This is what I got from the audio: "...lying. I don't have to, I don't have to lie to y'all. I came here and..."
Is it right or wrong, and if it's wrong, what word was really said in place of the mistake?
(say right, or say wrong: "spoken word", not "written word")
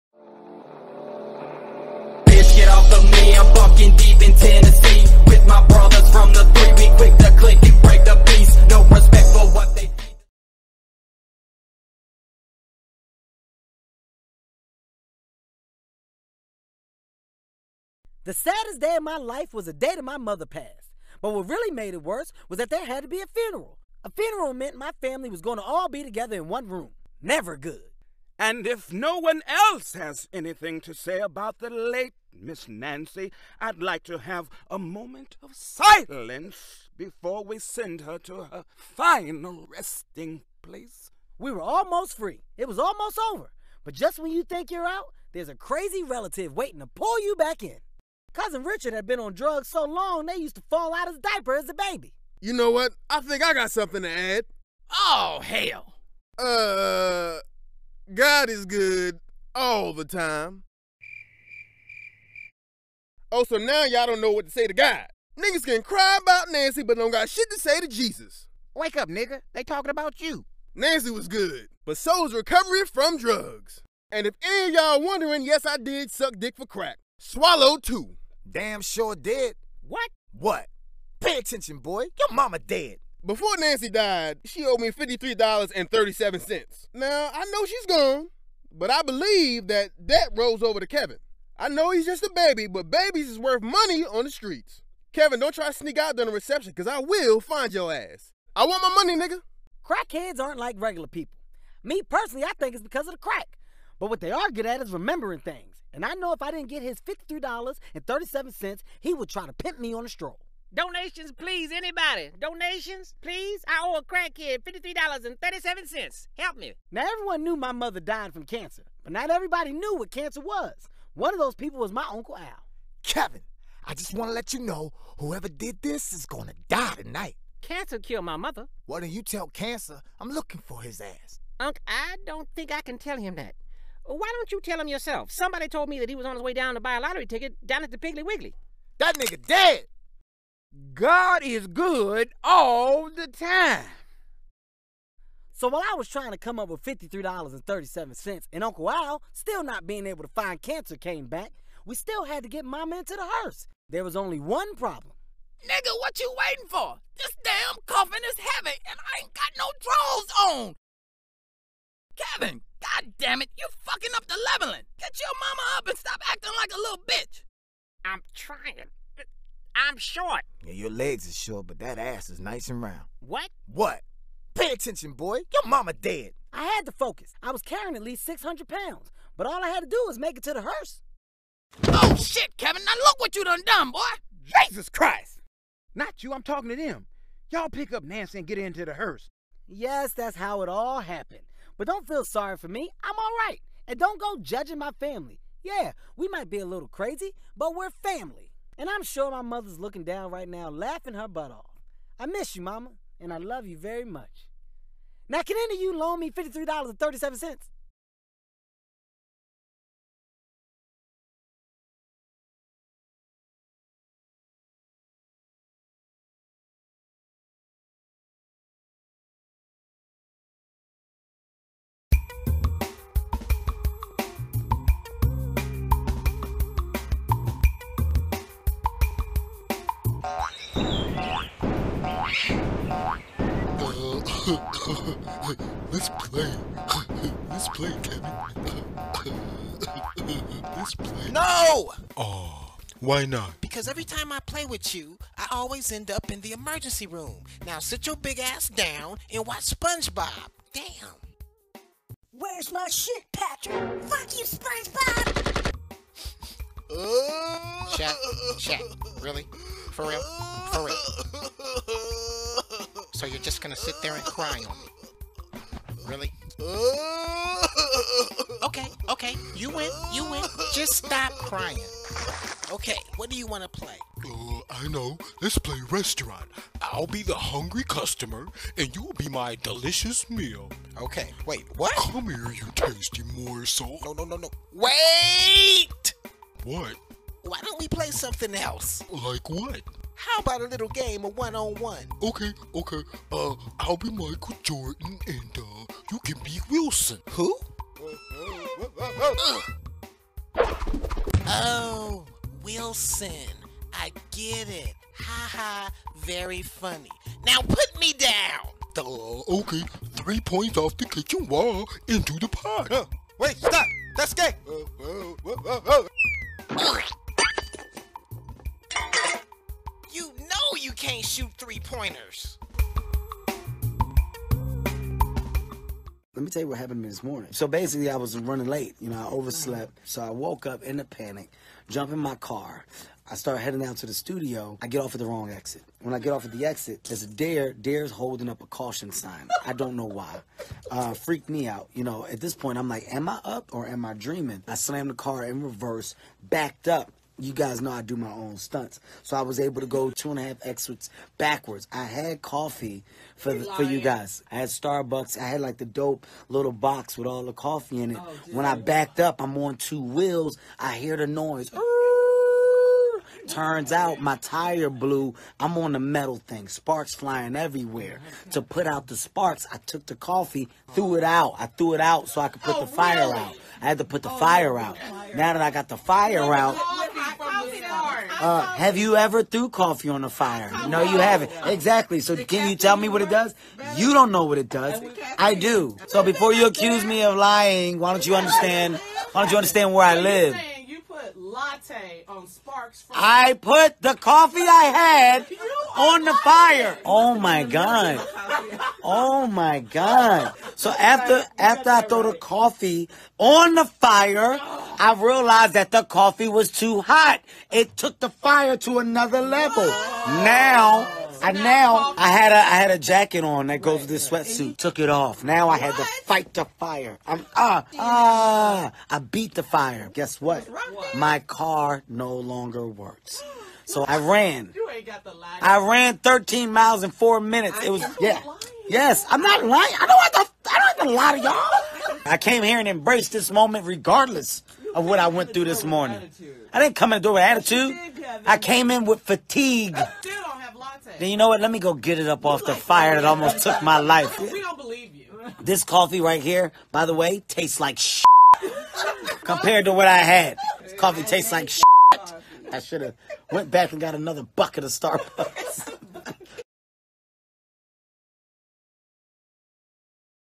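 right.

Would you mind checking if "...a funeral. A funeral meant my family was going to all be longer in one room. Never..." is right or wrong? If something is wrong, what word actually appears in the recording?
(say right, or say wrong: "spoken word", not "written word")
wrong: "together", not "longer".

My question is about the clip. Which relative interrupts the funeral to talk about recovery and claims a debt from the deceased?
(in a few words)
Cousin Richard.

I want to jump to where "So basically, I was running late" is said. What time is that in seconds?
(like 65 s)
327 s.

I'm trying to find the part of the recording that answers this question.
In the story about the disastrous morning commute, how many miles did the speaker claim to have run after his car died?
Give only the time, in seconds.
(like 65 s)
426 s.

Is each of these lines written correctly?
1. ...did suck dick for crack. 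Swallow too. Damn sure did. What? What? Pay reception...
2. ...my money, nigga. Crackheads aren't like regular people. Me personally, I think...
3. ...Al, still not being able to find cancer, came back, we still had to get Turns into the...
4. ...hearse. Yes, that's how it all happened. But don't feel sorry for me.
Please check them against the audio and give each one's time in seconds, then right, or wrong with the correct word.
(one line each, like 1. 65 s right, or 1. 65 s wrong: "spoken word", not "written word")
1. 75 s wrong: "attention", not "reception"
2. 98 s right
3. 148 s wrong: "Mama", not "Turns"
4. 188 s right.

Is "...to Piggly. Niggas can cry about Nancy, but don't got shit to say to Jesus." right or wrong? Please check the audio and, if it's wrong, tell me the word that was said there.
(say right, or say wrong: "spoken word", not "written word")
wrong: "God", not "Piggly".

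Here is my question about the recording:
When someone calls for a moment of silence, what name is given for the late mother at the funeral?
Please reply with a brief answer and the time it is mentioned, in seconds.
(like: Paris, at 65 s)
Miss Nancy, at 32 s.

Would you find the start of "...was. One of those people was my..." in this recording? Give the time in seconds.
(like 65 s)
120 s.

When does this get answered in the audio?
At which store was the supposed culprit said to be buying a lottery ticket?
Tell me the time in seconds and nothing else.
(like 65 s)
137 s.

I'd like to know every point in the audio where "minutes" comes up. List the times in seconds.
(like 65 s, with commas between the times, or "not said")
427 s.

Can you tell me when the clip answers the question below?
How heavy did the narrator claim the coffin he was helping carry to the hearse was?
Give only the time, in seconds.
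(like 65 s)
178 s.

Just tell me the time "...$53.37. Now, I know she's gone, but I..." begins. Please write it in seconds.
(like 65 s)
84 s.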